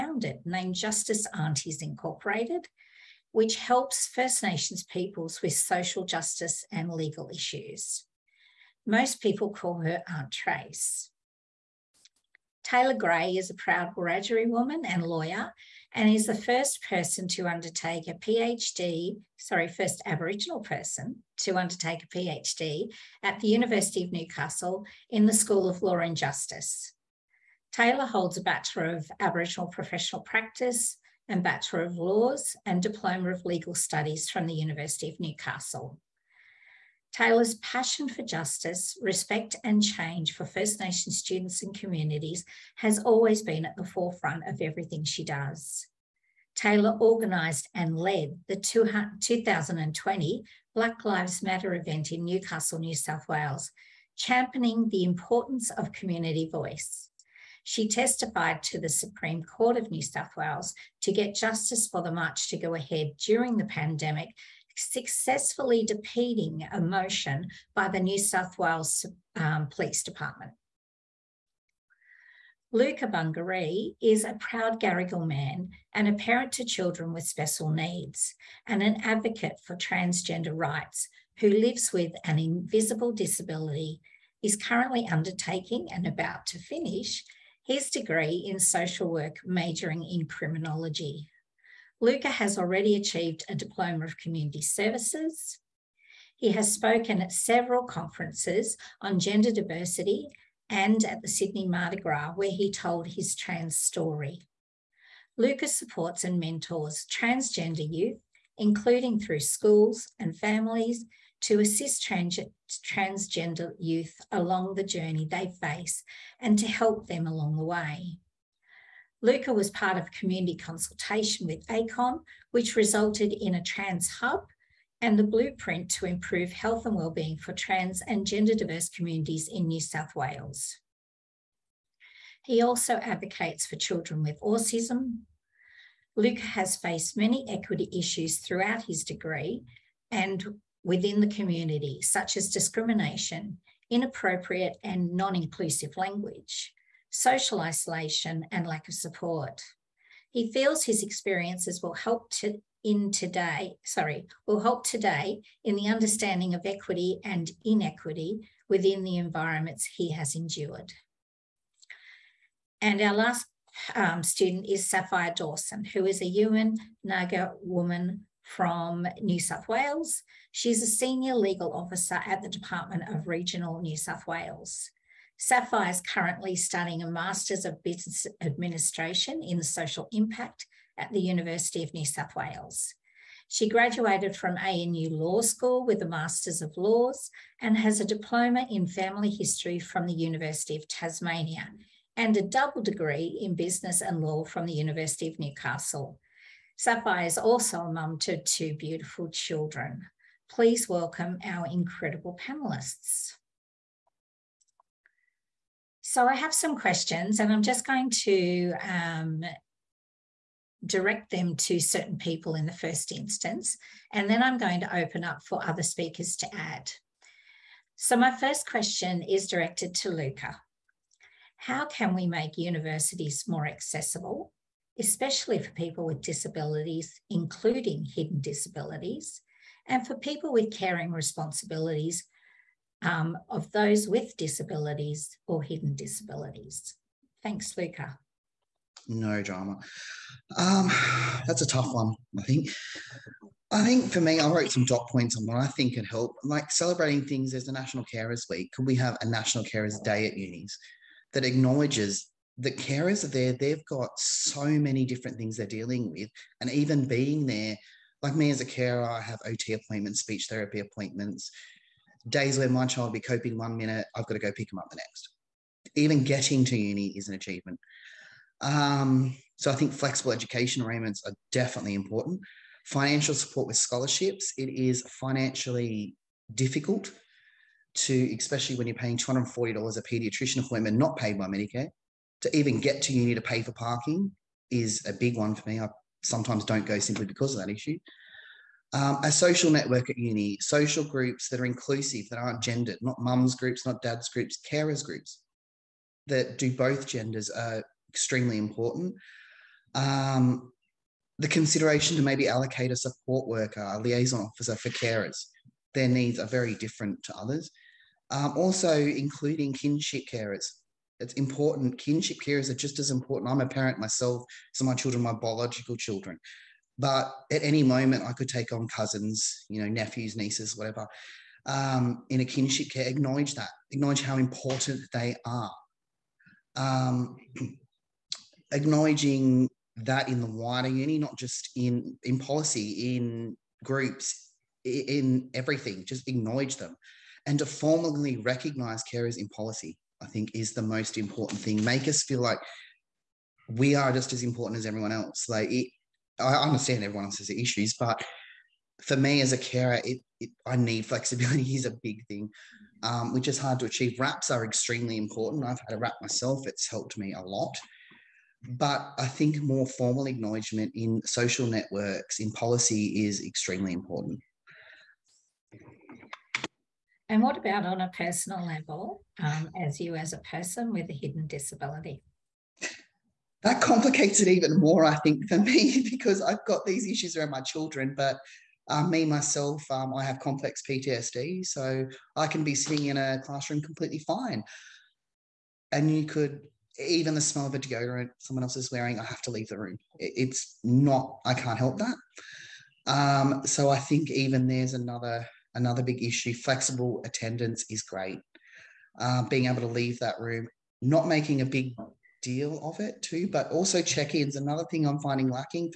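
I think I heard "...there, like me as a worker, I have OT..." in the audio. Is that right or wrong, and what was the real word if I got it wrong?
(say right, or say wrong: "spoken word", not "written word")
wrong: "carer", not "worker".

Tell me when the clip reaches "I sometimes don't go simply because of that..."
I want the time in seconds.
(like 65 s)
285 s.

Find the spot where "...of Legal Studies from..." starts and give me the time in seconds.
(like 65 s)
33 s.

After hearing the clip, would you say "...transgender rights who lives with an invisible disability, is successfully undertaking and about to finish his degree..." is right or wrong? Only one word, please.
wrong.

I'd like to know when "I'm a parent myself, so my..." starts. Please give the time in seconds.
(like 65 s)
313 s.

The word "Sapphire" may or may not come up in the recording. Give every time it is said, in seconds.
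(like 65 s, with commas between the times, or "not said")
164 s, 175 s, 196 s.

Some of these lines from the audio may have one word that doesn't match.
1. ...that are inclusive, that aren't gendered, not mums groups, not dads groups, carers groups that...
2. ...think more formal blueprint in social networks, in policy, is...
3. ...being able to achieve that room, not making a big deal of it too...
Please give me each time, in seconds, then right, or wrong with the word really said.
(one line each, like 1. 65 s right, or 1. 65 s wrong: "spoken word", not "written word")
1. 291 s right
2. 359 s wrong: "acknowledgement", not "blueprint"
3. 399 s wrong: "leave", not "achieve".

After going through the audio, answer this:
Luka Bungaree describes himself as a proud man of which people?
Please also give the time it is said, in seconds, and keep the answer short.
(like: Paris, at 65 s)
Garigal, at 74 s.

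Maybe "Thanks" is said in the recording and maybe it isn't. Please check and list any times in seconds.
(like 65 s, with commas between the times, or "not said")
237 s.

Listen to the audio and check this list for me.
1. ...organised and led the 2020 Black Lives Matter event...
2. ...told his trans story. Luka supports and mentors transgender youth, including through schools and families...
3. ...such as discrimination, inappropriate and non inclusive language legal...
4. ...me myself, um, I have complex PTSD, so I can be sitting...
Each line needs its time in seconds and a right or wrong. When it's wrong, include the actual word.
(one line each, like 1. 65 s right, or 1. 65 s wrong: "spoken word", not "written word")
1. 47 s right
2. 102 s right
3. 142 s wrong: "social", not "legal"
4. 379 s right.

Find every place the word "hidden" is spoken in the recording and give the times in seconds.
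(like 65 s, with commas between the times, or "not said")
228 s, 235 s, 371 s.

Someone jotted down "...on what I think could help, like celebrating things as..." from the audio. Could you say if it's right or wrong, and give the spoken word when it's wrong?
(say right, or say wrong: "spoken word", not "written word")
right.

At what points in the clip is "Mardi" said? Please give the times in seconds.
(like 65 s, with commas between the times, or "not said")
101 s.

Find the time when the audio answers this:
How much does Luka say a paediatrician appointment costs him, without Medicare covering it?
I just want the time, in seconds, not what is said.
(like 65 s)
279 s.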